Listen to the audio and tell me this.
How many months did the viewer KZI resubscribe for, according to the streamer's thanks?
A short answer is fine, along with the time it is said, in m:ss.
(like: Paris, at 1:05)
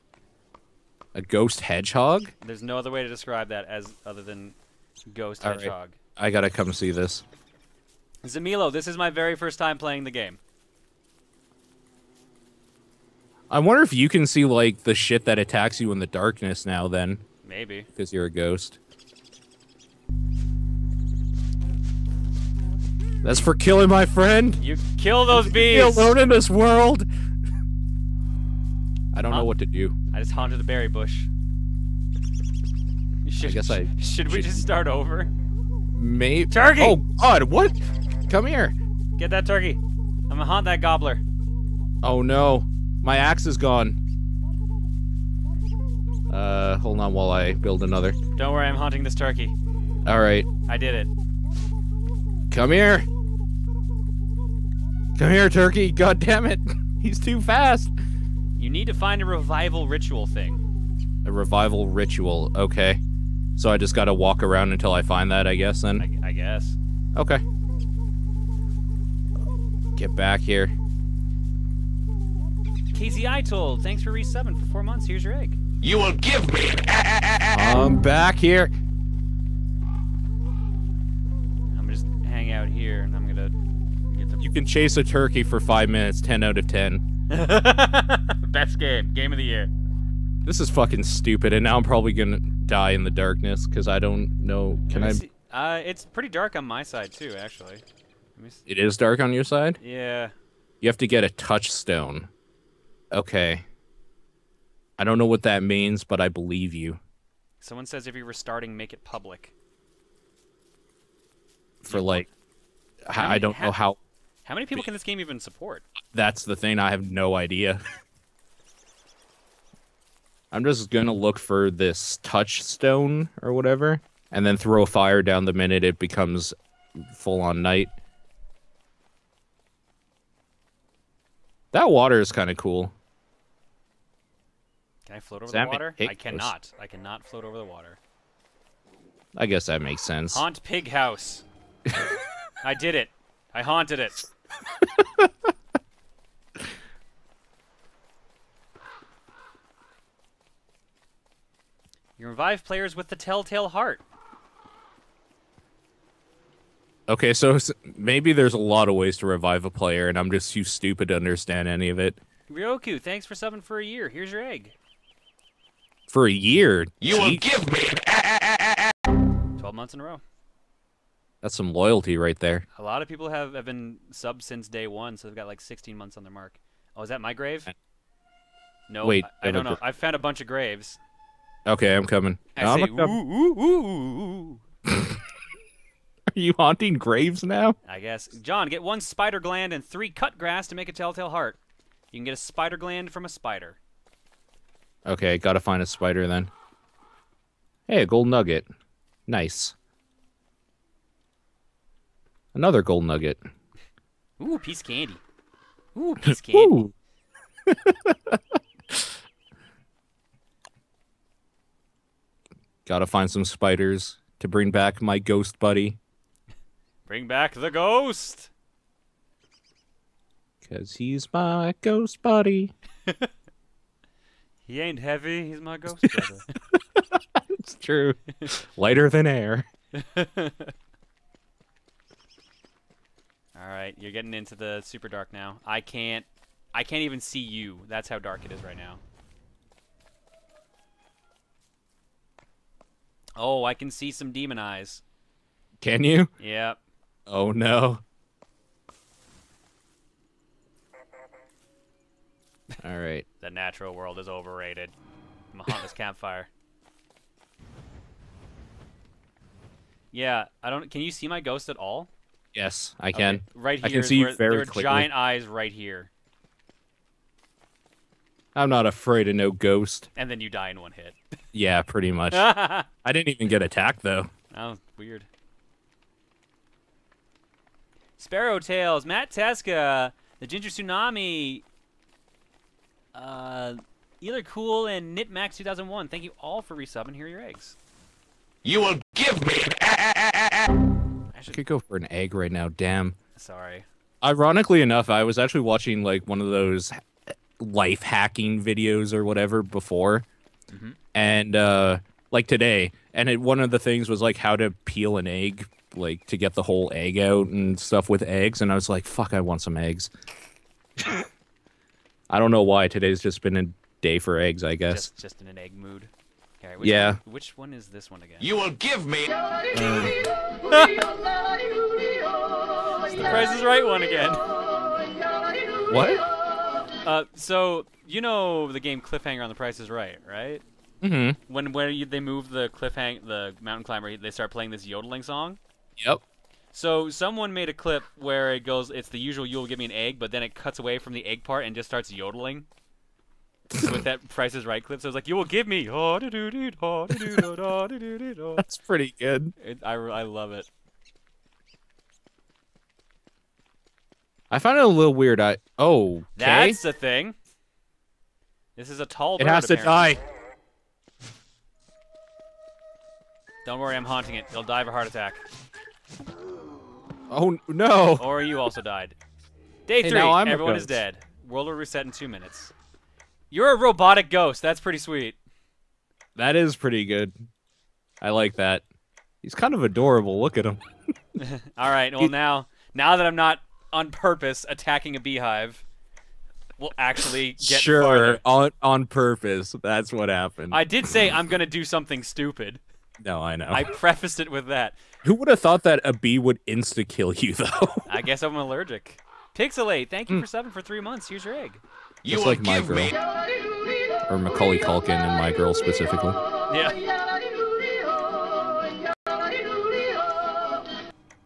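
4, at 1:14.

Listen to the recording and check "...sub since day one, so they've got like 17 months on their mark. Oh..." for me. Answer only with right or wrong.
wrong.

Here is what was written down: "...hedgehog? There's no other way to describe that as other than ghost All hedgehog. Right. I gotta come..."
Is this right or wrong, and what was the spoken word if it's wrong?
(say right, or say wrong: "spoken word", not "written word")
right.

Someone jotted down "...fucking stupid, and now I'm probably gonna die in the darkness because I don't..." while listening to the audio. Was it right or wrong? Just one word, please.
right.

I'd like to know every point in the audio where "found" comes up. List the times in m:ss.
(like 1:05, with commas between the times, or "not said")
2:59, 5:54.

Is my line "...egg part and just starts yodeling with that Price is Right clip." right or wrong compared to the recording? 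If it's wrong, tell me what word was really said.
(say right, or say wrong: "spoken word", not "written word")
right.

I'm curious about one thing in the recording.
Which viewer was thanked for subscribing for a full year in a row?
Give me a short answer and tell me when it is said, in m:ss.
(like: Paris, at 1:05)
Ryoku, at 2:42.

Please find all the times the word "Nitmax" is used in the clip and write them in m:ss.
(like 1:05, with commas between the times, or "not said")
4:45.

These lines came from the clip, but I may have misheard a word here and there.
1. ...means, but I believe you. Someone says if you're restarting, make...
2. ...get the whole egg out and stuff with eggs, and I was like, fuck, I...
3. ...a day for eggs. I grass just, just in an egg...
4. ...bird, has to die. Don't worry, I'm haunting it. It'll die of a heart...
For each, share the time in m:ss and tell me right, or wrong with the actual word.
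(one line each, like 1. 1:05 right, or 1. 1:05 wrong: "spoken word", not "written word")
1. 1:45 right
2. 5:06 right
3. 5:13 wrong: "guess", not "grass"
4. 5:59 right.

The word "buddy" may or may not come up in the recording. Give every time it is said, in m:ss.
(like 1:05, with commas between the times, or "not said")
3:35, 3:42.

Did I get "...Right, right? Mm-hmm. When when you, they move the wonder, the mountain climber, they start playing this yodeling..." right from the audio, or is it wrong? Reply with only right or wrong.
wrong.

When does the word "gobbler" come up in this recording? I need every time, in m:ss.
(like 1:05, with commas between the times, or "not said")
0:40.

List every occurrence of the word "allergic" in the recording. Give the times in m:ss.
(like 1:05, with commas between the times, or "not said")
6:38.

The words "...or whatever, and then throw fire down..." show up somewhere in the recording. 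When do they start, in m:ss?
2:03.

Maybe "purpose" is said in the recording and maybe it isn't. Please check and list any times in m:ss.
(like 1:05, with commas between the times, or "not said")
6:24, 6:29.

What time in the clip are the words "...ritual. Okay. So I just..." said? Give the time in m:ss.
1:01.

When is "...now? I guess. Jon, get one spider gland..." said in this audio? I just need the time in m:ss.
3:07.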